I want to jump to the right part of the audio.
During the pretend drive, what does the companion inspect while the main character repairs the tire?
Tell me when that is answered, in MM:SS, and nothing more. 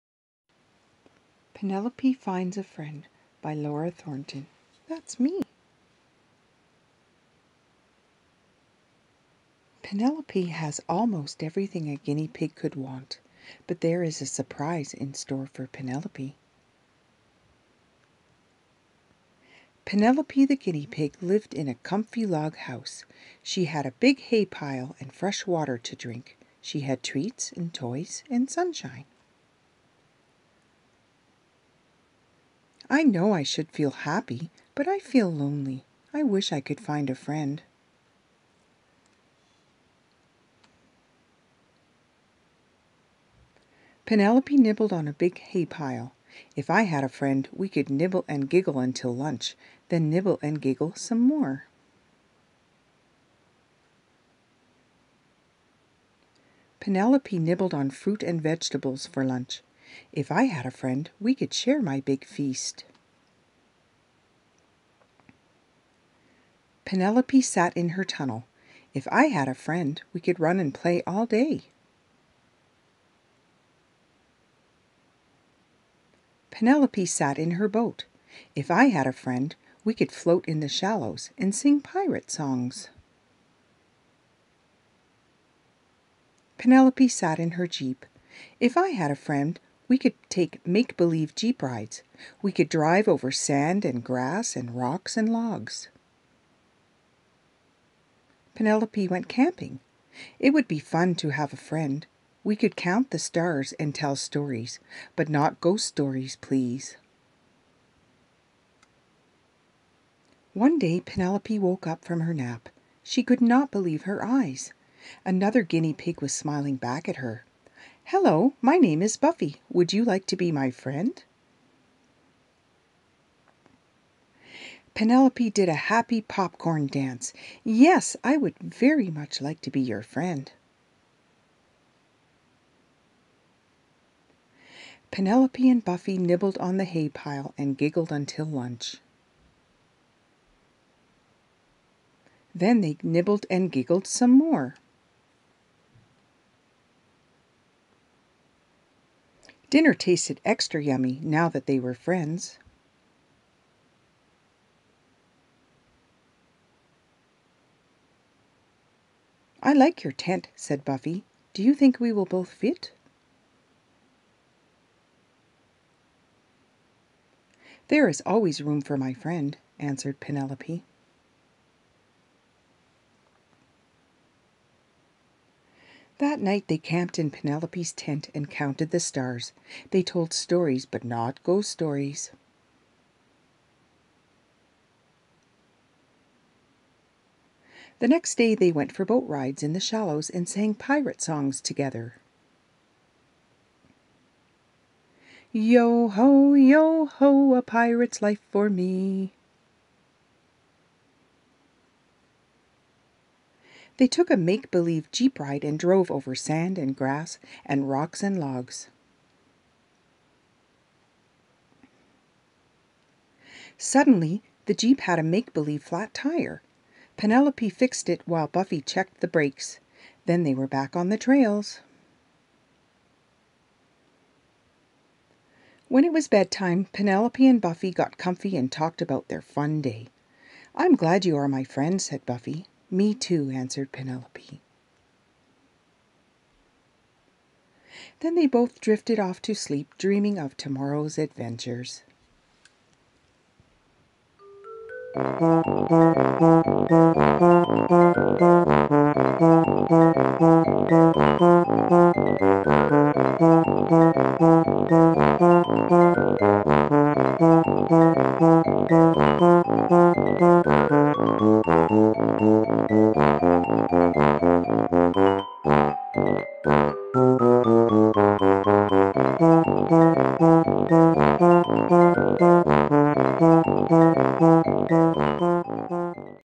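03:39.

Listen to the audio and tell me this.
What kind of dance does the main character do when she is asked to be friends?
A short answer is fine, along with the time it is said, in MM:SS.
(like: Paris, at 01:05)
Popcorn dance, at 02:06.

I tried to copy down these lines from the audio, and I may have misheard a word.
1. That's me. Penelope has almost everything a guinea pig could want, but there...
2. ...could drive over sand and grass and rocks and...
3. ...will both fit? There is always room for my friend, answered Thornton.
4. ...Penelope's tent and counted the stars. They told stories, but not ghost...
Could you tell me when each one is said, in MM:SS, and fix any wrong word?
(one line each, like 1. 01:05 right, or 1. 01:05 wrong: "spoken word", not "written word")
1. 00:04 right
2. 01:32 right
3. 02:42 wrong: "Penelope", not "Thornton"
4. 02:57 right.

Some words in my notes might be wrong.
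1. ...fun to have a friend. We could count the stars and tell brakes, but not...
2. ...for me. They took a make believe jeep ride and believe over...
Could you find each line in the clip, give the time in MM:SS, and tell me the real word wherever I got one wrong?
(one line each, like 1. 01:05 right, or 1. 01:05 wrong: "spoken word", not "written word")
1. 01:40 wrong: "stories", not "brakes"
2. 03:18 wrong: "drove", not "believe".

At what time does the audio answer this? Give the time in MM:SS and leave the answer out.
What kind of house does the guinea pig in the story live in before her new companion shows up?
00:21.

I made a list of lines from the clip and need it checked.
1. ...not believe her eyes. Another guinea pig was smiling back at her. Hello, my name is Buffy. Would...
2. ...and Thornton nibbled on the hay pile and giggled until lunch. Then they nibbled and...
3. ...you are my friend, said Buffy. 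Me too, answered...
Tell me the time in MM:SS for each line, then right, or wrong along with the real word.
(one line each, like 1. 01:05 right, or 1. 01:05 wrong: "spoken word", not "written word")
1. 01:53 right
2. 02:15 wrong: "Buffy", not "Thornton"
3. 03:51 right.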